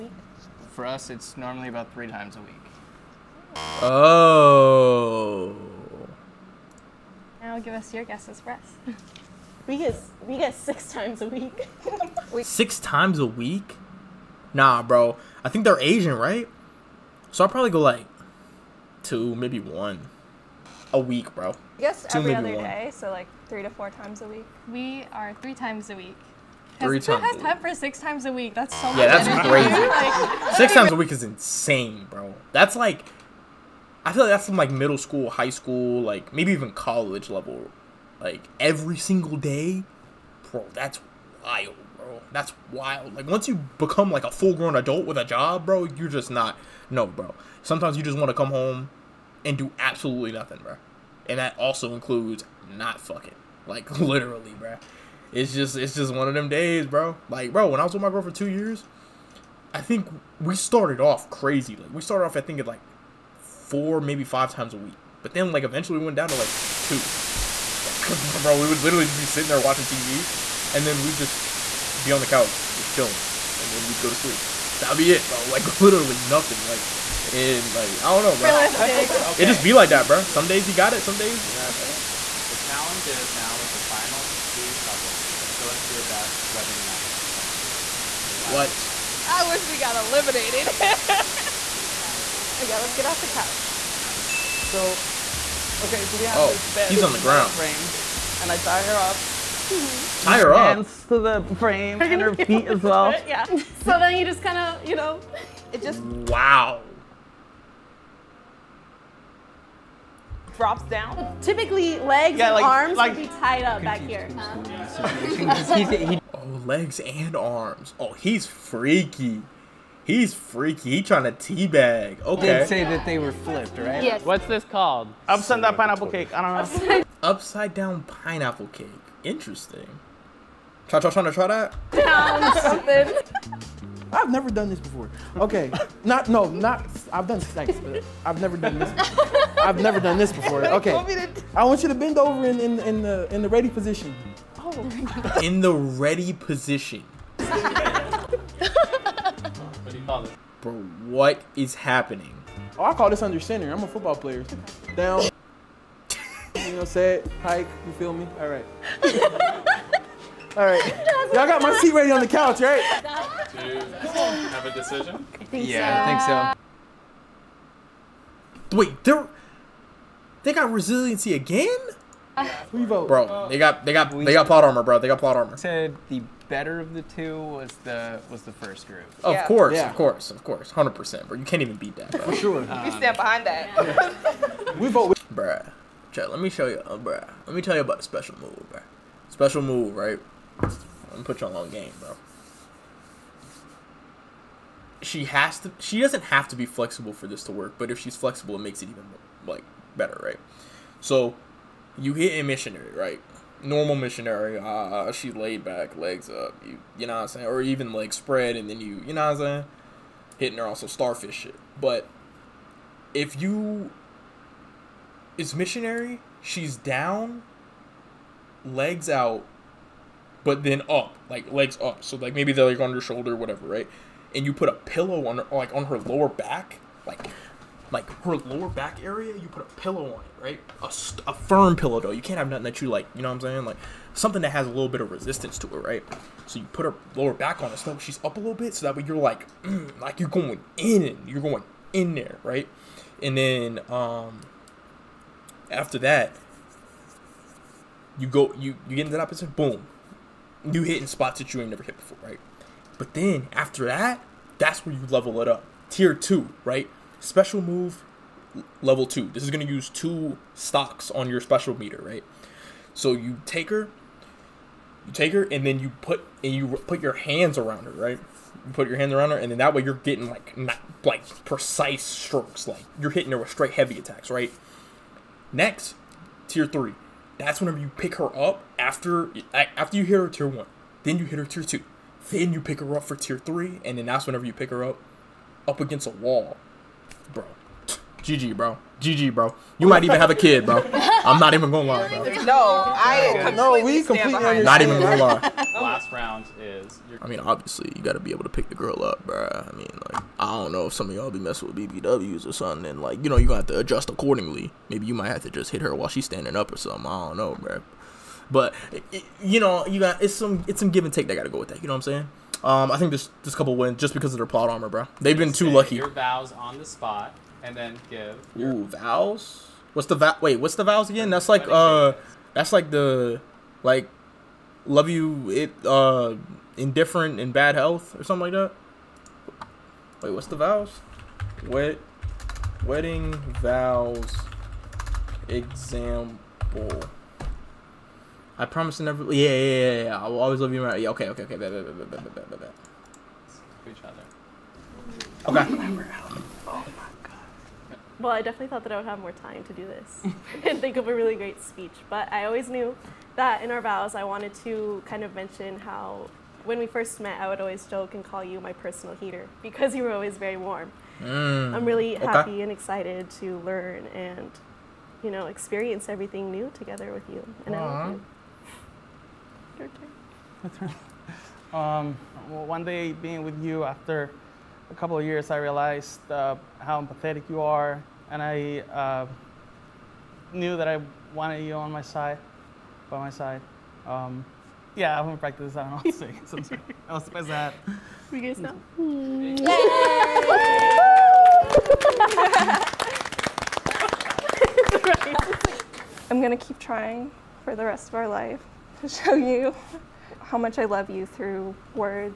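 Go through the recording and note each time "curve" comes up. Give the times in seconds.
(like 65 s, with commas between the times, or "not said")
not said.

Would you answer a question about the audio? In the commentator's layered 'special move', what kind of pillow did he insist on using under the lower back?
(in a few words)
firm pillow.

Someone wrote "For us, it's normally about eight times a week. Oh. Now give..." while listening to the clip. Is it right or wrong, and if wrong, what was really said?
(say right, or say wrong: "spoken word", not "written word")
wrong: "three", not "eight".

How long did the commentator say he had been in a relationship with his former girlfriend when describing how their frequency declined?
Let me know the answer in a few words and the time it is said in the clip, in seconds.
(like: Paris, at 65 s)
2 years, at 58 s.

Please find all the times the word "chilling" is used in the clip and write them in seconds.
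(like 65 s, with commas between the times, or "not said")
72 s.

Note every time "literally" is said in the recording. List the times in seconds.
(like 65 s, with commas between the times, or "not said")
53 s, 68 s, 75 s.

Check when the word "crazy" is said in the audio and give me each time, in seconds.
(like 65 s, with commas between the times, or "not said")
30 s, 61 s.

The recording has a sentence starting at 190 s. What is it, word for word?
I'm gonna put you on long game, bro.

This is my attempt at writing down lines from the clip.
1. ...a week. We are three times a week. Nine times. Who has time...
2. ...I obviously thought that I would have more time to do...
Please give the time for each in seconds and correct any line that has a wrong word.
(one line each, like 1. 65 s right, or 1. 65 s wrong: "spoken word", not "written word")
1. 24 s wrong: "Three", not "Nine"
2. 348 s wrong: "definitely", not "obviously".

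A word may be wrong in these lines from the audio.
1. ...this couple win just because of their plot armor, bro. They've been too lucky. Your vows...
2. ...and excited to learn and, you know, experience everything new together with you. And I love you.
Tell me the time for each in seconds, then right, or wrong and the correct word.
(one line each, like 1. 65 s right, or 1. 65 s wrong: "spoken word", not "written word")
1. 313 s right
2. 362 s right.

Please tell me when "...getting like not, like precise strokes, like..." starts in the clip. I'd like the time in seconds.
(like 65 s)
269 s.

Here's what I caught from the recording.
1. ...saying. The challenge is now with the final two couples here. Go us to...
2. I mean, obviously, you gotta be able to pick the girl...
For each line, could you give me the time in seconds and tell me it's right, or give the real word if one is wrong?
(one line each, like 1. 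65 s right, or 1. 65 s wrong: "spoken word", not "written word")
1. 81 s right
2. 297 s right.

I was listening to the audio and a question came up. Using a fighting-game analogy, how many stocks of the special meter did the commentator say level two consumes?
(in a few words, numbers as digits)
2.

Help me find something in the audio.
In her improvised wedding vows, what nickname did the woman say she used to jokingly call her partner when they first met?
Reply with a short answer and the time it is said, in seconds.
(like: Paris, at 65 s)
personal heater, at 358 s.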